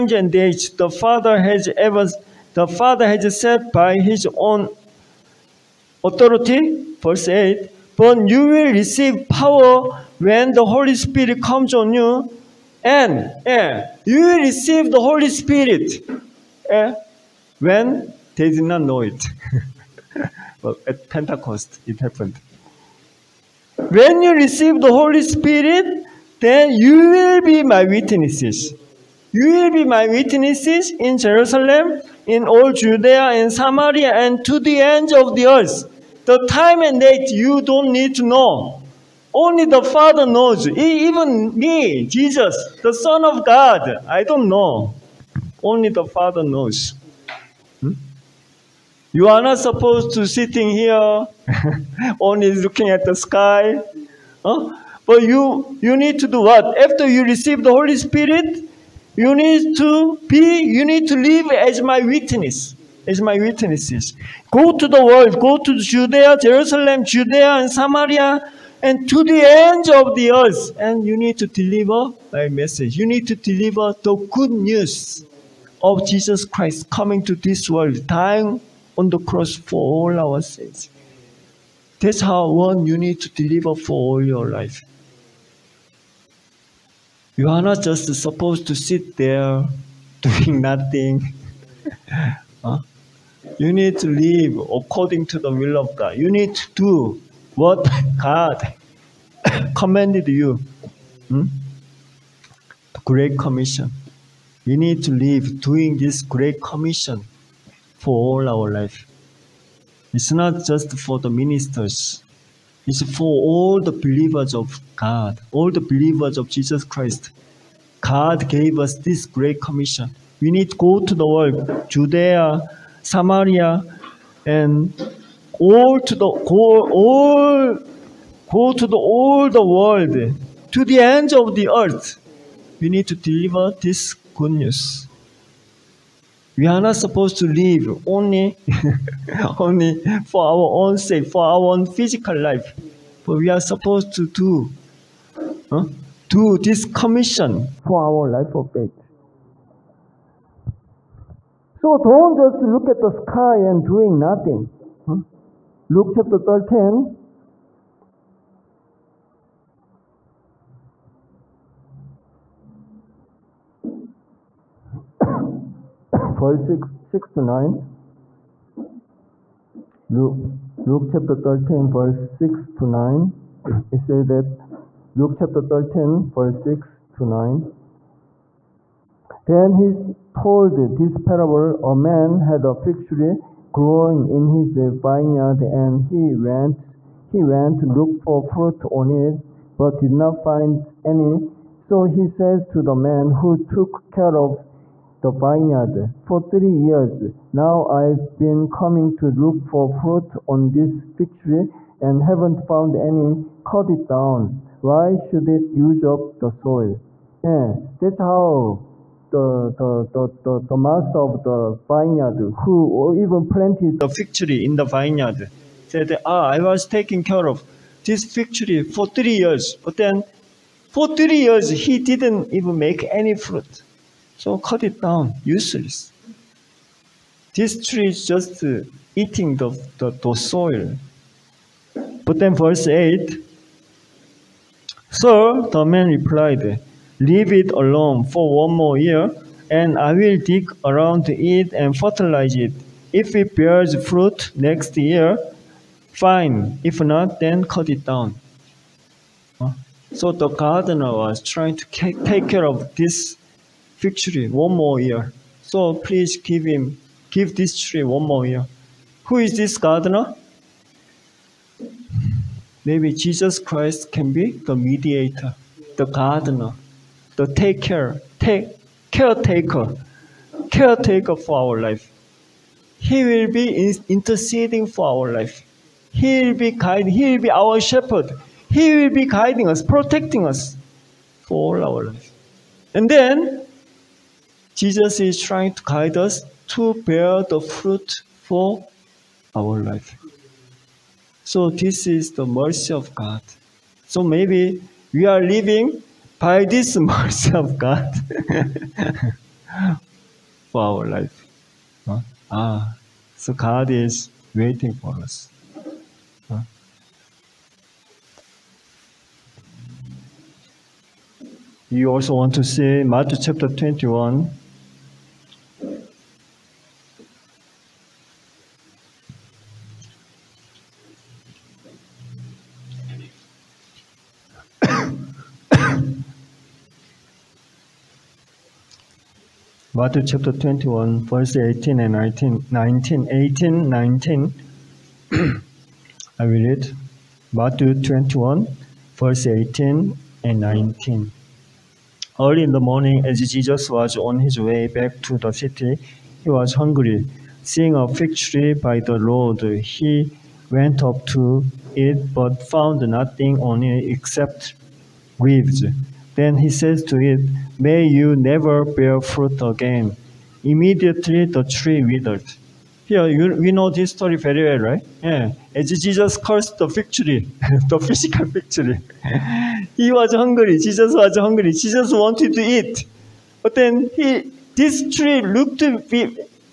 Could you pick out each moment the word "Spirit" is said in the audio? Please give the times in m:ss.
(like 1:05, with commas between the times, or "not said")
0:10, 0:15, 0:25, 0:57.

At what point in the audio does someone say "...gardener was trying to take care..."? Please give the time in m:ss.
4:10.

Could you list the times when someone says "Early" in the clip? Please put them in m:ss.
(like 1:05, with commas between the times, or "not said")
5:42.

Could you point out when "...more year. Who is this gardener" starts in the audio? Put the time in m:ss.
4:18.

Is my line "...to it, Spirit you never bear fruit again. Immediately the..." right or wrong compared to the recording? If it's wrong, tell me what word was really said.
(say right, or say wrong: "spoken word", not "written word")
wrong: "May", not "Spirit".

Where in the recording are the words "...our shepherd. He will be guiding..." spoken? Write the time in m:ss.
4:37.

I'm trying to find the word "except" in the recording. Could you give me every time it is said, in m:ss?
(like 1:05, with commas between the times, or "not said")
5:54.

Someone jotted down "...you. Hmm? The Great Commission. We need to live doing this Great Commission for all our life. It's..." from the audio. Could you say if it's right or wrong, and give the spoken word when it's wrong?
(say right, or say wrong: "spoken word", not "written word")
right.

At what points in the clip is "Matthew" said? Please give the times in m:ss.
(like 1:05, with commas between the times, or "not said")
5:13, 5:29, 5:37.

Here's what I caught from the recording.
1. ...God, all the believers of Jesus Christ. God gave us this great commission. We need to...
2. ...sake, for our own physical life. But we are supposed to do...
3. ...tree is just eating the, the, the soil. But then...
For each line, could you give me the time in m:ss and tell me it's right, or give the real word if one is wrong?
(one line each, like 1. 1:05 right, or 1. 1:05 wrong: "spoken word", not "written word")
1. 1:54 right
2. 2:20 right
3. 3:47 right.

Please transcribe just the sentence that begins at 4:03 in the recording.
If it bears fruit next year, fine.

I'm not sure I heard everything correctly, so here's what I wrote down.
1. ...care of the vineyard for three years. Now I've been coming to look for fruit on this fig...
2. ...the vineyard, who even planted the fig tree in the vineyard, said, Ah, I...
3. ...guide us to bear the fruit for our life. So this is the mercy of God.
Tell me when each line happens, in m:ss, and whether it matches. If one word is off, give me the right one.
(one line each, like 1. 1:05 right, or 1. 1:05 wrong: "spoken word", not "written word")
1. 3:14 right
2. 3:31 right
3. 4:45 right.